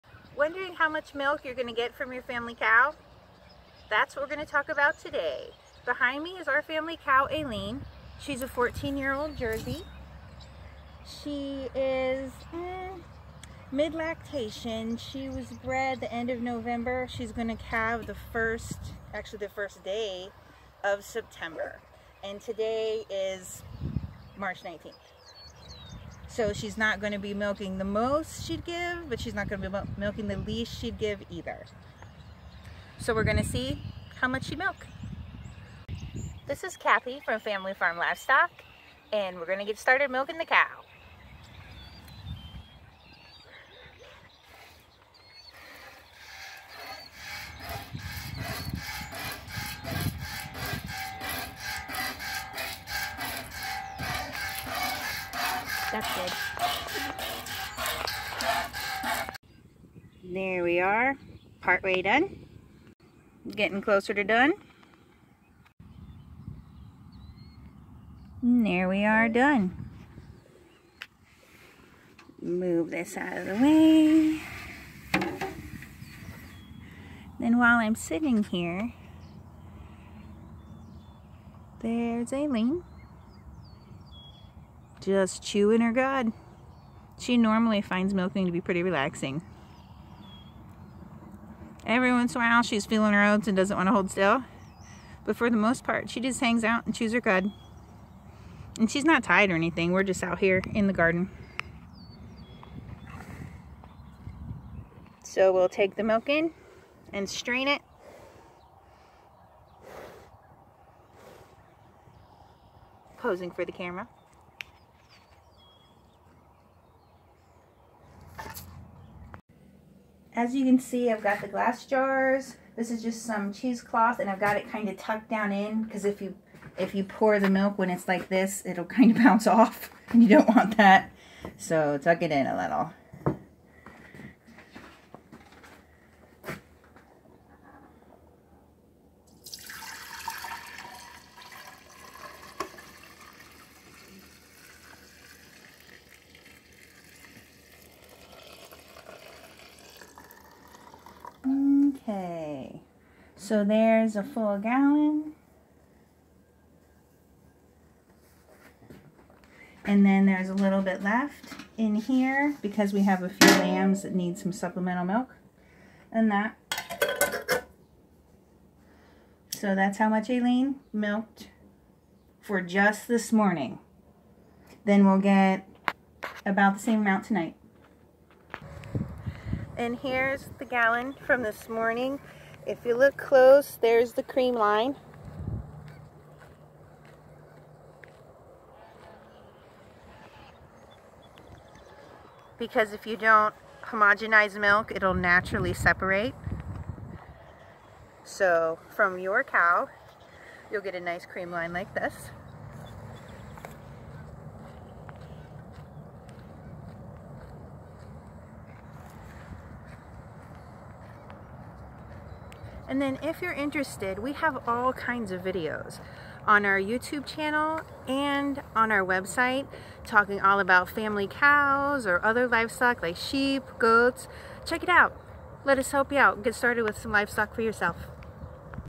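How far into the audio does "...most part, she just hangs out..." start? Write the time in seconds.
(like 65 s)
95 s.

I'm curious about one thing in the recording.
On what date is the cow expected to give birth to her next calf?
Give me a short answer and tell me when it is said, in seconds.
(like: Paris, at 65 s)
September 1, at 19 s.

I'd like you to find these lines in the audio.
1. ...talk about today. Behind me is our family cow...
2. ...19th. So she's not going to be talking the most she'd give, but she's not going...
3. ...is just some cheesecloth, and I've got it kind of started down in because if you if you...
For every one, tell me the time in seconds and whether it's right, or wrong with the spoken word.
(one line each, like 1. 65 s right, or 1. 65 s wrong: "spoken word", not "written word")
1. 4 s right
2. 24 s wrong: "milking", not "talking"
3. 122 s wrong: "tucked", not "started".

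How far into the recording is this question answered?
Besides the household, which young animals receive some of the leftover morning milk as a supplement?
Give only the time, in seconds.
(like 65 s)
163 s.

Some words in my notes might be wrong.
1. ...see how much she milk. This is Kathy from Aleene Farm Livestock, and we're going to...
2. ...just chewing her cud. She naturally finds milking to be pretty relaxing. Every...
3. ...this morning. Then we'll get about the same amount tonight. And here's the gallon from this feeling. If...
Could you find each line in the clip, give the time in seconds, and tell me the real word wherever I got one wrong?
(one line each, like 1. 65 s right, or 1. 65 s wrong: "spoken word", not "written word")
1. 33 s wrong: "Family", not "Aleene"
2. 85 s wrong: "normally", not "naturally"
3. 173 s wrong: "morning", not "feeling".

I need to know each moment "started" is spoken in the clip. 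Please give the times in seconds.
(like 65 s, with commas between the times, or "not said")
39 s, 226 s.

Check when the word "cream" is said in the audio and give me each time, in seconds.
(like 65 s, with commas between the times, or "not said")
184 s, 201 s.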